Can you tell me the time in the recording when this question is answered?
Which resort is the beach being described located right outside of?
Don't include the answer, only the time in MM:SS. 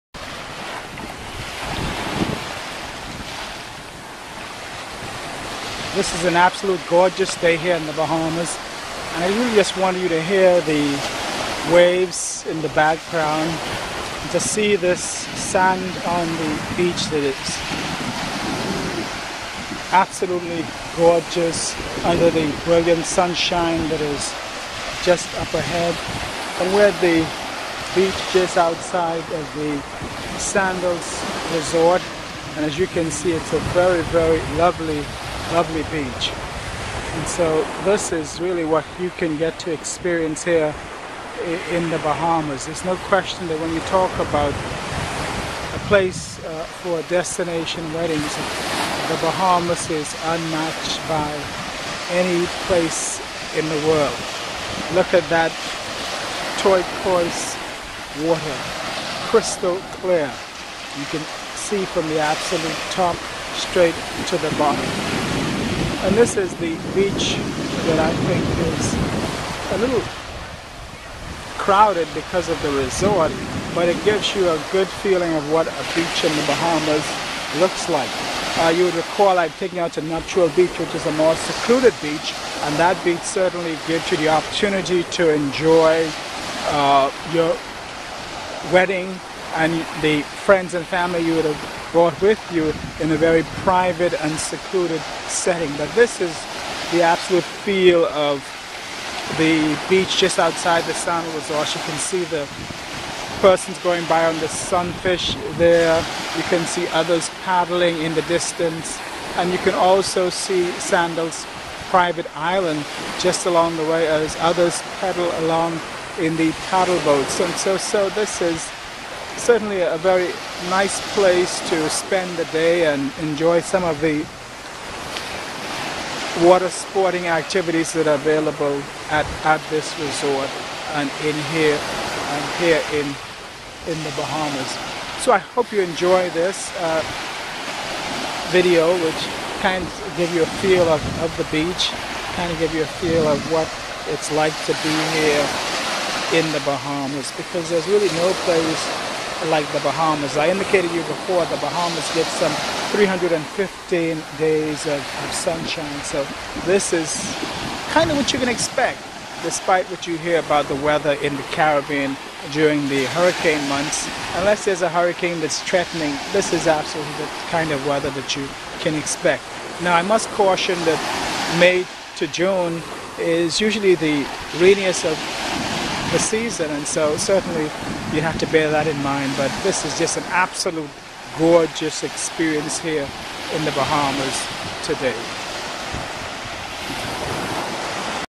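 00:30.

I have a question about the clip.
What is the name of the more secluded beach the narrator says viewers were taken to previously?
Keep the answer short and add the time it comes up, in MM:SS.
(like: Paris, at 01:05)
Nuptial Beach, at 01:20.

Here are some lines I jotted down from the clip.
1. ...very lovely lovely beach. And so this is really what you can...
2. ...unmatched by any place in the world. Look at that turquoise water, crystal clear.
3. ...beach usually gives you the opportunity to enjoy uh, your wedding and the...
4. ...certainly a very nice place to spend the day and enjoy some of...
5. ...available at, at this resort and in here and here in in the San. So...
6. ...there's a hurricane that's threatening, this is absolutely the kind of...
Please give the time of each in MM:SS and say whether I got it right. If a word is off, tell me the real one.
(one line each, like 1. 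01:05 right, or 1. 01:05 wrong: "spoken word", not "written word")
1. 00:34 right
2. 00:50 right
3. 01:23 wrong: "certainly", not "usually"
4. 01:59 right
5. 02:08 wrong: "Bahamas", not "San"
6. 02:44 right.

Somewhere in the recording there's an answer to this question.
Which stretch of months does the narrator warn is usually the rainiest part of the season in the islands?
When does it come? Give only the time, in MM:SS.
02:51.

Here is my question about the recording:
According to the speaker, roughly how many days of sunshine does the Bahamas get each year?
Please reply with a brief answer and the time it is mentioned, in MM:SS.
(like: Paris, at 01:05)
315, at 02:32.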